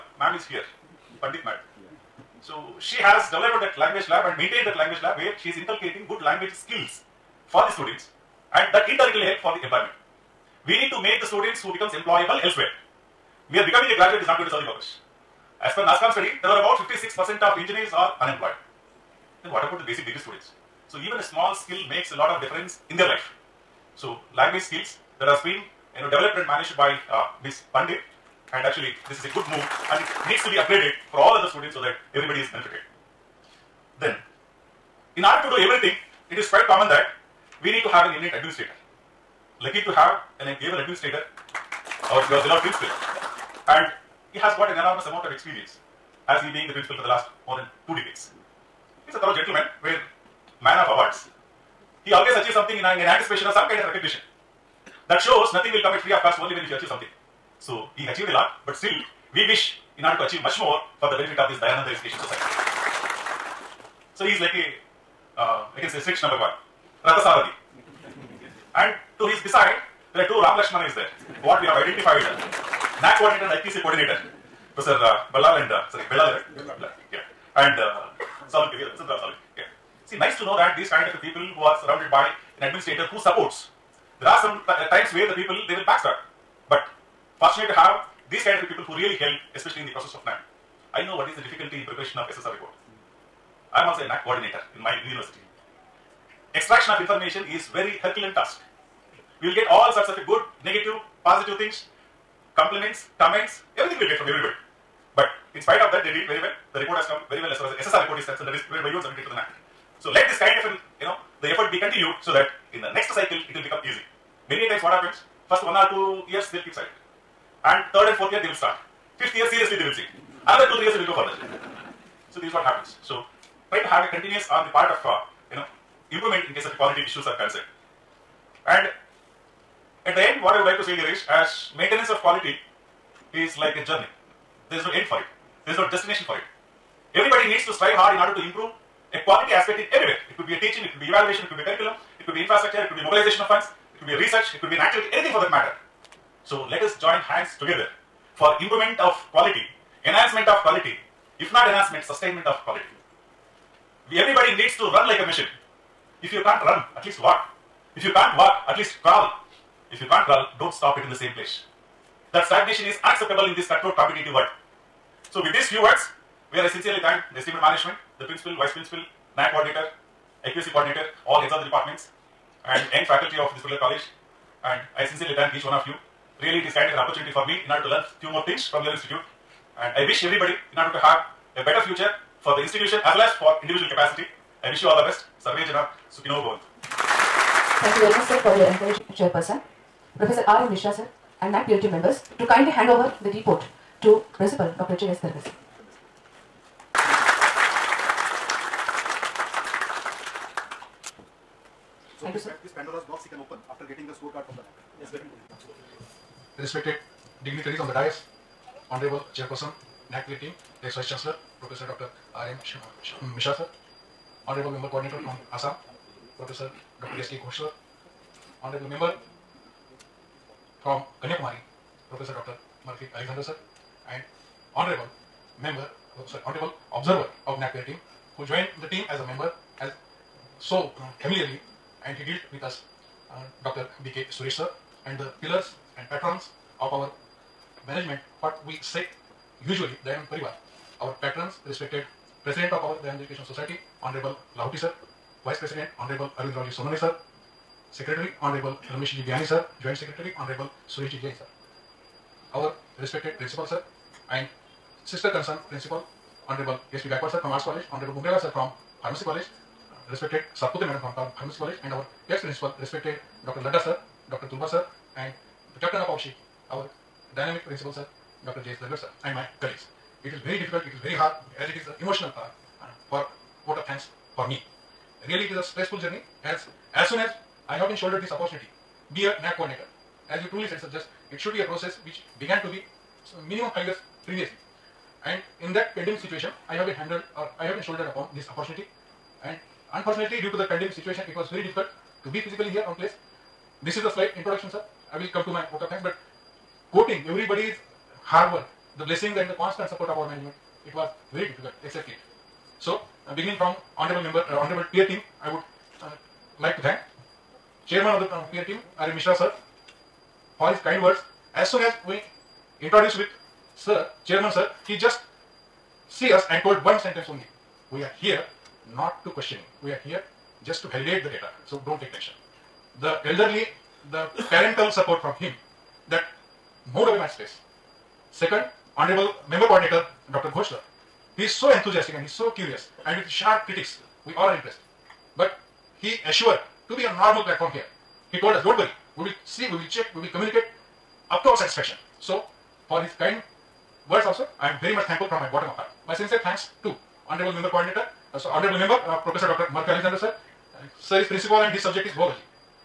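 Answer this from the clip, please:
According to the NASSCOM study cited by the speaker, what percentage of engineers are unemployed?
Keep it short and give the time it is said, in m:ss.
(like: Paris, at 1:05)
56%, at 0:16.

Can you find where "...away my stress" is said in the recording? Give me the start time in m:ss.
5:27.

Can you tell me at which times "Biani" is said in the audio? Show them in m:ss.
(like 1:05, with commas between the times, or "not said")
4:09.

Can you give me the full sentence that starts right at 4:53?
This is the slight introduction sir.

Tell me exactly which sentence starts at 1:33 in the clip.
I am also a NAAC coordinator in my university.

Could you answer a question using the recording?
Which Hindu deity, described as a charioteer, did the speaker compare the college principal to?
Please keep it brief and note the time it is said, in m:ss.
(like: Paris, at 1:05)
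Sri Krishna, at 1:05.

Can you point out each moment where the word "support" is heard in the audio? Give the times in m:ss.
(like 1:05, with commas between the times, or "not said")
1:23, 4:59, 5:24.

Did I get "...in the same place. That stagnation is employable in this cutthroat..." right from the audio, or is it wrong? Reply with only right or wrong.
wrong.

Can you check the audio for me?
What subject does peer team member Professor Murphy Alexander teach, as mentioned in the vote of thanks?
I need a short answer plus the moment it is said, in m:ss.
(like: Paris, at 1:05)
Zoology, at 5:52.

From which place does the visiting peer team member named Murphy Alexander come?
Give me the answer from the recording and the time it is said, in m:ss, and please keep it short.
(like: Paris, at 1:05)
Kanyakumari, at 3:41.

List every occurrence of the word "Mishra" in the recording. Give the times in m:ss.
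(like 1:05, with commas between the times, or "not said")
3:10, 3:33, 5:09.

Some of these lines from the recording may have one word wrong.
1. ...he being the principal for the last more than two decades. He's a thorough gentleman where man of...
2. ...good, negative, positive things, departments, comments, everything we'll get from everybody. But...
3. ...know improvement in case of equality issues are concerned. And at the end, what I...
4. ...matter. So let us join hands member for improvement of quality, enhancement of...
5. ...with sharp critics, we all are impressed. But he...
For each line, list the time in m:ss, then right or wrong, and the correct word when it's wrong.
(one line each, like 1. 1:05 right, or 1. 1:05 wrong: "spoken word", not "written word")
1. 0:46 right
2. 1:40 wrong: "compliments", not "departments"
3. 2:05 right
4. 2:25 wrong: "together", not "member"
5. 5:33 right.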